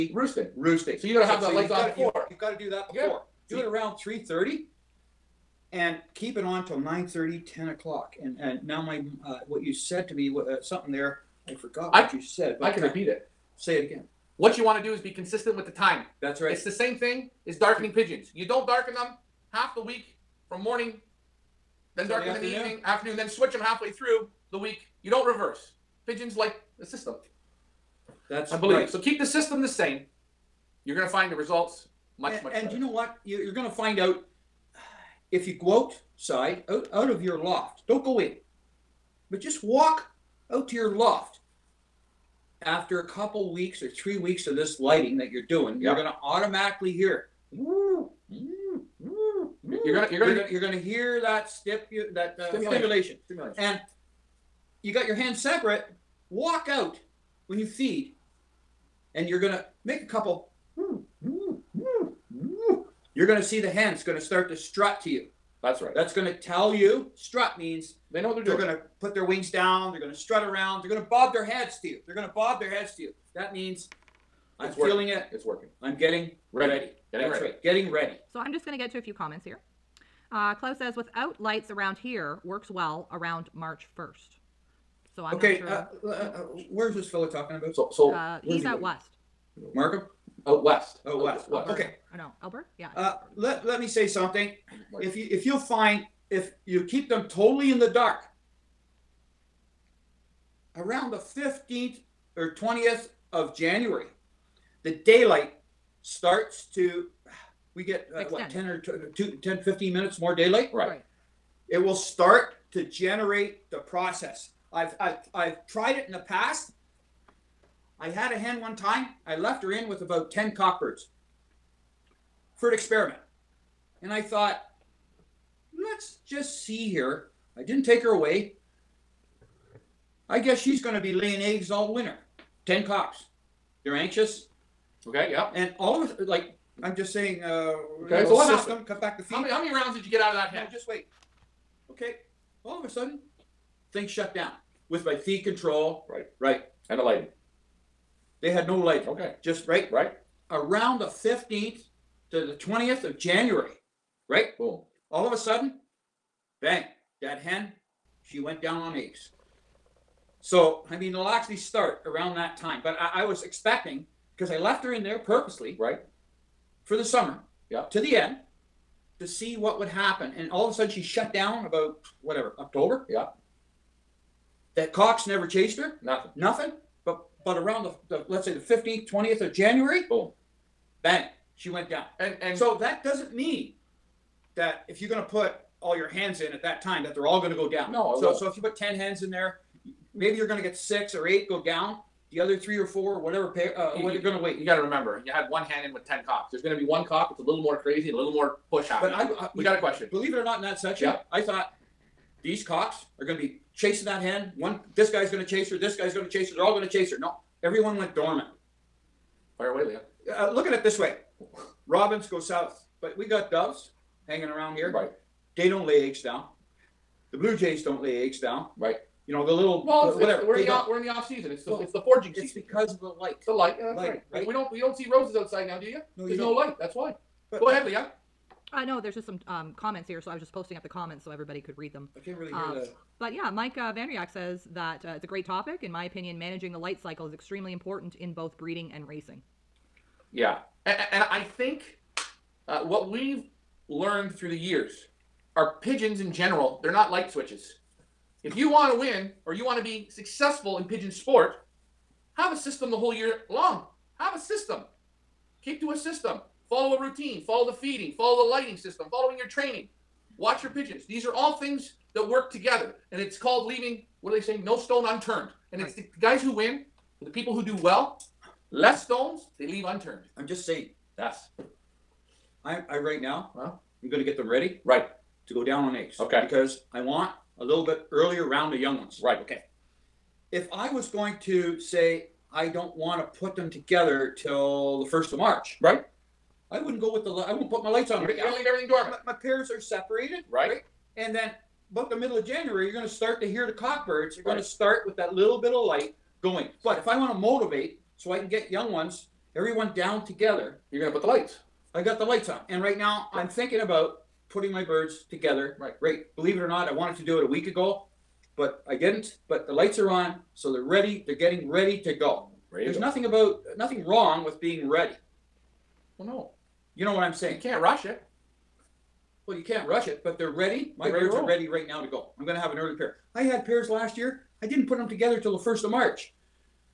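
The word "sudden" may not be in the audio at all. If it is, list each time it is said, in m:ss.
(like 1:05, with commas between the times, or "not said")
2:22, 2:35, 2:50.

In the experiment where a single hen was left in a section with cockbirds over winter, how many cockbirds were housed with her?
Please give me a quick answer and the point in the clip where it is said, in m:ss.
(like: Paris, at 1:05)
10, at 2:00.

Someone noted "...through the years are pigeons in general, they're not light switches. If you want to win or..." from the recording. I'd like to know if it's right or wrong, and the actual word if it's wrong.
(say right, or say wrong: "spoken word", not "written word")
right.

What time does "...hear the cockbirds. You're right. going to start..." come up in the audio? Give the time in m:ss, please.
4:53.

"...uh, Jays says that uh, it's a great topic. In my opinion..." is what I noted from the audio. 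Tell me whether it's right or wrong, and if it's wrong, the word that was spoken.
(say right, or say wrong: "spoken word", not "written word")
wrong: "Vanriak", not "Jays".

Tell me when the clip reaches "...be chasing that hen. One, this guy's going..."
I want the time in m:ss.
3:23.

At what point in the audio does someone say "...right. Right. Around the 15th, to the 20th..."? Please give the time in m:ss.
2:29.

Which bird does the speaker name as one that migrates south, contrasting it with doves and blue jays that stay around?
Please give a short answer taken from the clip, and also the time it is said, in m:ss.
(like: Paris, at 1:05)
Robins, at 3:31.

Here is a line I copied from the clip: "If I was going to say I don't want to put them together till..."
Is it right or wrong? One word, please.
right.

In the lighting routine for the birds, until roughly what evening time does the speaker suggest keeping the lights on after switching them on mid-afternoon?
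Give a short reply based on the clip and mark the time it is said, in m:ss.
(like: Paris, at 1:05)
9:30, at 0:06.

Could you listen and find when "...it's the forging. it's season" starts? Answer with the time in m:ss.
3:41.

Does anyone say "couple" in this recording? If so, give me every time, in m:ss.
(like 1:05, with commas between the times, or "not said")
0:43, 1:00.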